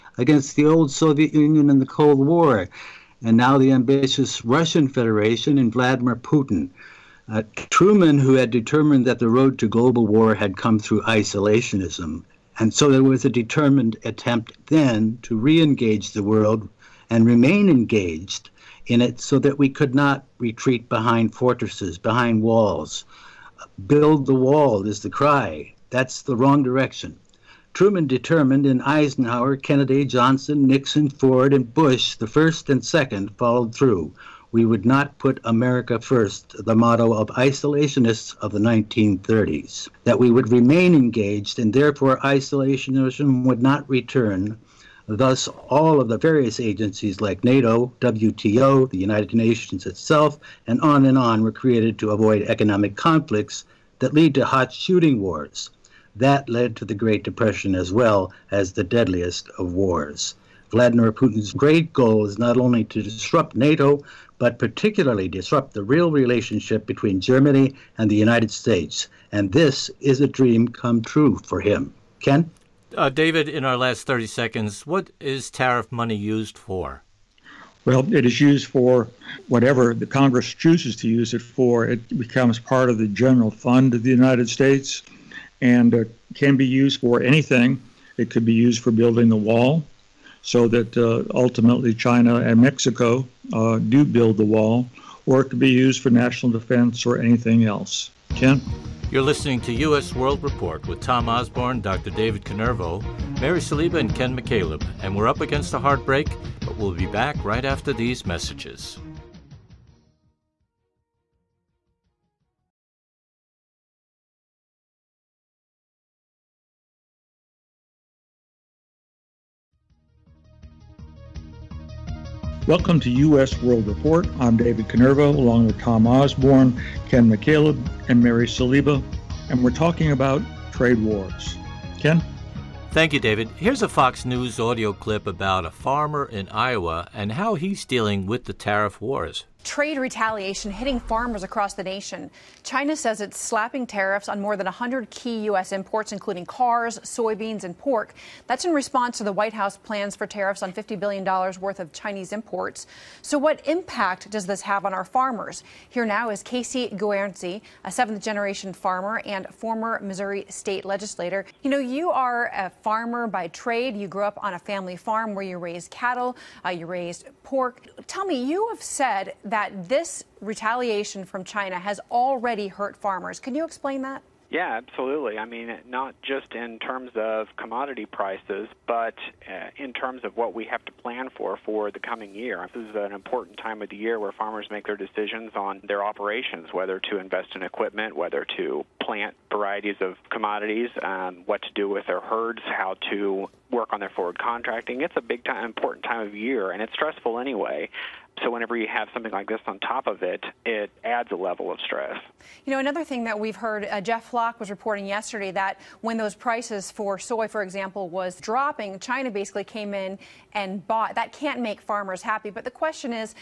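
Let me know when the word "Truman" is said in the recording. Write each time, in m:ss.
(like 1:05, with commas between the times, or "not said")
0:07, 0:27.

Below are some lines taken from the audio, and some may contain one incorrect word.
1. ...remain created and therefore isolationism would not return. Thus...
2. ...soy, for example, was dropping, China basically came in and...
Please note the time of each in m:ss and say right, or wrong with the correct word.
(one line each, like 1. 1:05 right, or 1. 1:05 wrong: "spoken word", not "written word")
1. 0:40 wrong: "engaged", not "created"
2. 3:27 right.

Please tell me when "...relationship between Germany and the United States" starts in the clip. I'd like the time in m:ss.
1:06.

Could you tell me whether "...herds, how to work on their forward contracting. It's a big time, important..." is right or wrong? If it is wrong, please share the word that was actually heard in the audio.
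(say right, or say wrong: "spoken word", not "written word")
right.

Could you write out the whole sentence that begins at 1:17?
Well, it is used for whatever the Congress chooses to use it for.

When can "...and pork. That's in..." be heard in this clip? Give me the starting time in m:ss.
2:27.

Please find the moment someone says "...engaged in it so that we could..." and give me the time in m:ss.
0:17.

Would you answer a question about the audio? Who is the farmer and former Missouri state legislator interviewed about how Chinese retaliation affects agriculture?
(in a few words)
Casey Guernsey.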